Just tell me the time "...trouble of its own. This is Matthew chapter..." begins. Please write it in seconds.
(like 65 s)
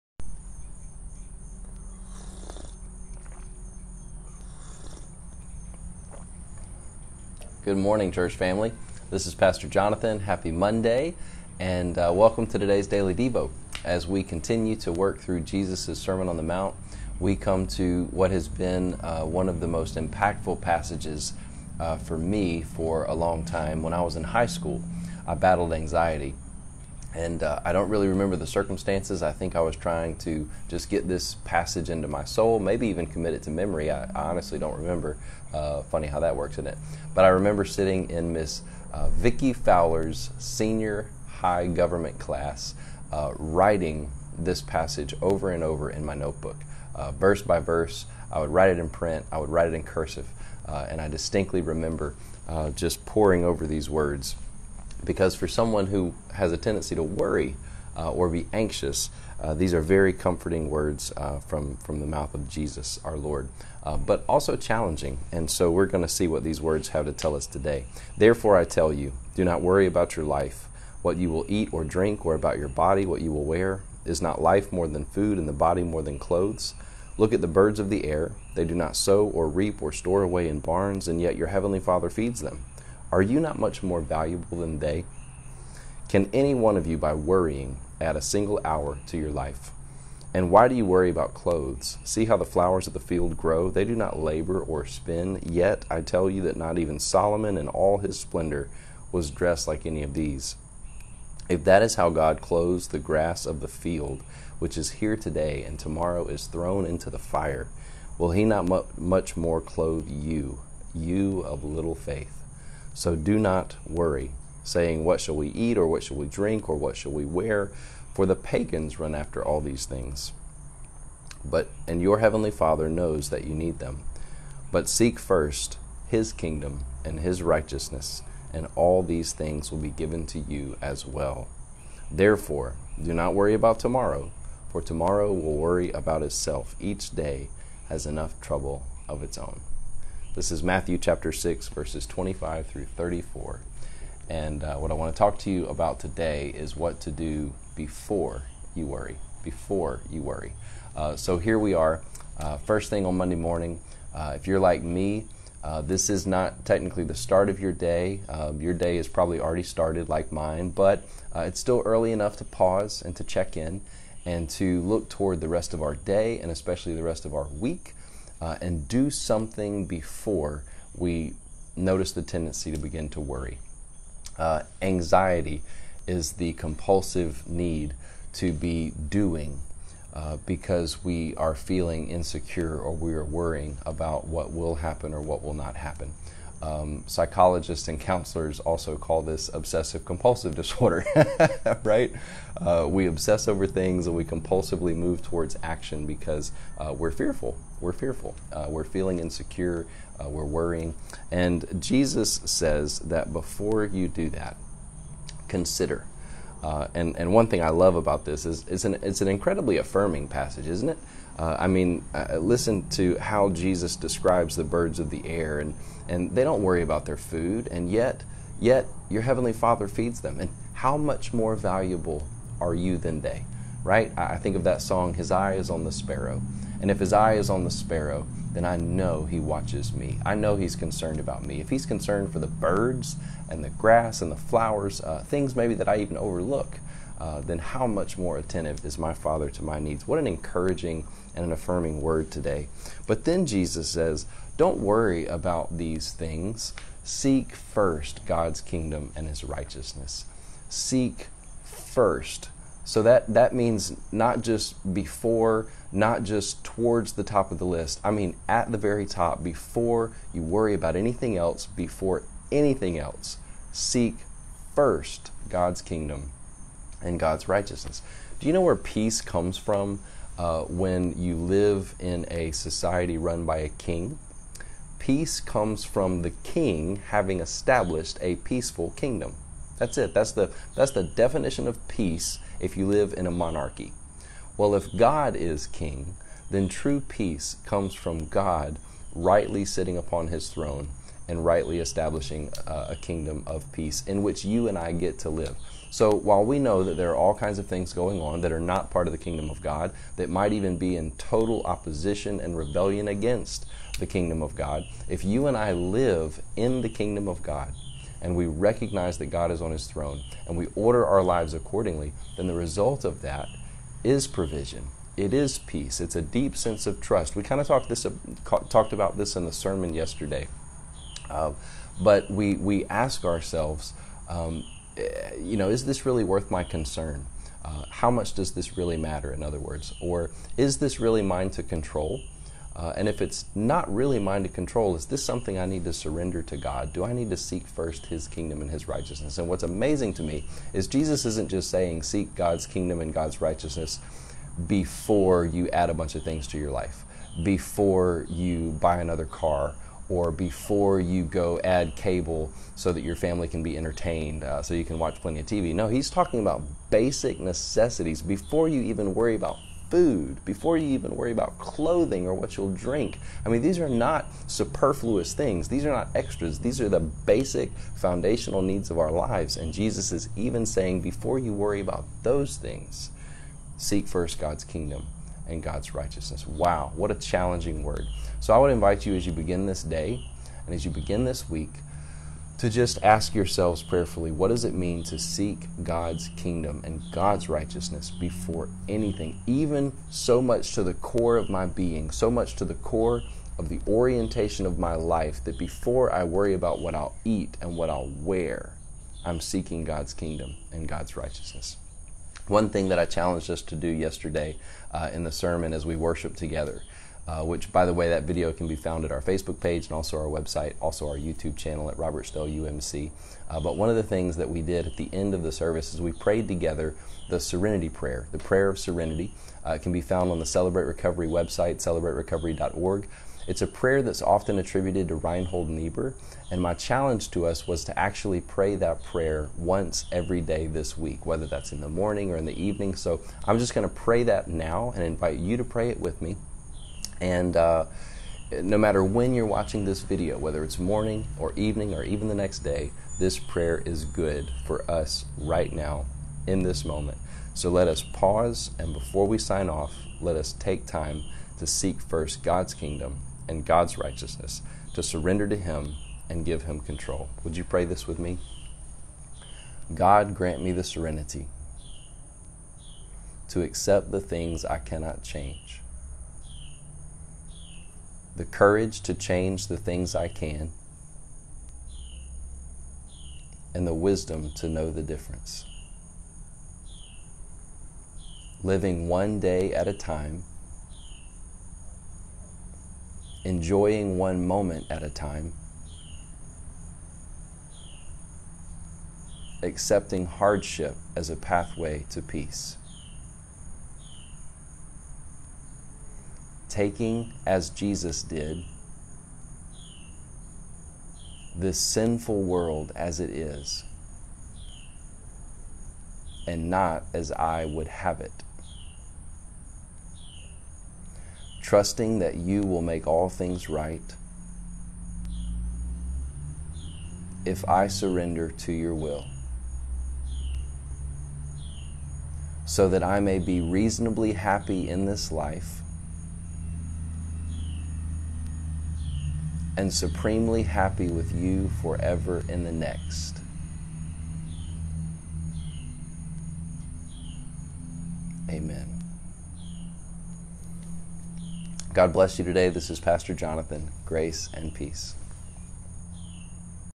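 138 s.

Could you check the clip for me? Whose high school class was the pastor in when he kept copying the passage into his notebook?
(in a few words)
Vicki Fowler.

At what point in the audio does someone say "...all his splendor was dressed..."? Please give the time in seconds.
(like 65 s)
97 s.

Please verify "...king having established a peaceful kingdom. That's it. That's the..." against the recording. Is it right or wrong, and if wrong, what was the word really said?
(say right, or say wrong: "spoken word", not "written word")
right.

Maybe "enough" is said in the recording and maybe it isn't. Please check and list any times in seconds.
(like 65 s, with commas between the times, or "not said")
138 s, 162 s.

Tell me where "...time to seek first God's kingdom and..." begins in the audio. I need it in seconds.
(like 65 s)
450 s.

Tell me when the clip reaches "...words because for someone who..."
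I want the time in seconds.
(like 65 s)
53 s.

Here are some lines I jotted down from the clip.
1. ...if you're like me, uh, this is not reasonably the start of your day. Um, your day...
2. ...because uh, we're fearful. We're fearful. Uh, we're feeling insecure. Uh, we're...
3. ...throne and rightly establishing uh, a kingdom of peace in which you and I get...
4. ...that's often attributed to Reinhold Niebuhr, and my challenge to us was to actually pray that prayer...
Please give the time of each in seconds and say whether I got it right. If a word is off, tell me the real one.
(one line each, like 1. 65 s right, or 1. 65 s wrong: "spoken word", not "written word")
1. 154 s wrong: "technically", not "reasonably"
2. 196 s right
3. 290 s right
4. 424 s right.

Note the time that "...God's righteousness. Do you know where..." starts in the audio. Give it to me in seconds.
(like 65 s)
267 s.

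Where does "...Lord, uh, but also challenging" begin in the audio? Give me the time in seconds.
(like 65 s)
63 s.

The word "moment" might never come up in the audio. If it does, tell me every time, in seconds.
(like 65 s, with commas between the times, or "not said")
446 s, 484 s.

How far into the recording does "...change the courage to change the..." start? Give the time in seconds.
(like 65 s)
465 s.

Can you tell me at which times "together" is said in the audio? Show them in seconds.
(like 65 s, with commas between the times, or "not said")
406 s, 416 s.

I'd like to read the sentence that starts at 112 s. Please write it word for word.
So do not worry, saying, What shall we eat, or what shall we drink, or what shall we wear?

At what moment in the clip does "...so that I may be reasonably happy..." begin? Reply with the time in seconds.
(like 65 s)
522 s.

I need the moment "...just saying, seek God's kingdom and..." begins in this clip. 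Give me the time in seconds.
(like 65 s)
341 s.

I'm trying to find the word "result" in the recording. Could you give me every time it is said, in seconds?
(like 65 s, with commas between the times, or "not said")
312 s.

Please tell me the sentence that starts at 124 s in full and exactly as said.
But seek first his kingdom and his righteousness, and all these things will be given to you as well.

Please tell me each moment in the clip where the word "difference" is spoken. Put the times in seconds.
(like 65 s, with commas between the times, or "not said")
475 s.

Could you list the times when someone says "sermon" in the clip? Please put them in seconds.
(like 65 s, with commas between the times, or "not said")
15 s, 319 s, 405 s.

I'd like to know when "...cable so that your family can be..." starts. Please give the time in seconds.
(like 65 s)
351 s.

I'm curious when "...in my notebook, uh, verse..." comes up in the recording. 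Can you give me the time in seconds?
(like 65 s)
45 s.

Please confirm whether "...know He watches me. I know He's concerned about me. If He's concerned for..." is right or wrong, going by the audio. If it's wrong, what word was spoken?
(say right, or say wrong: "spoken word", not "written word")
right.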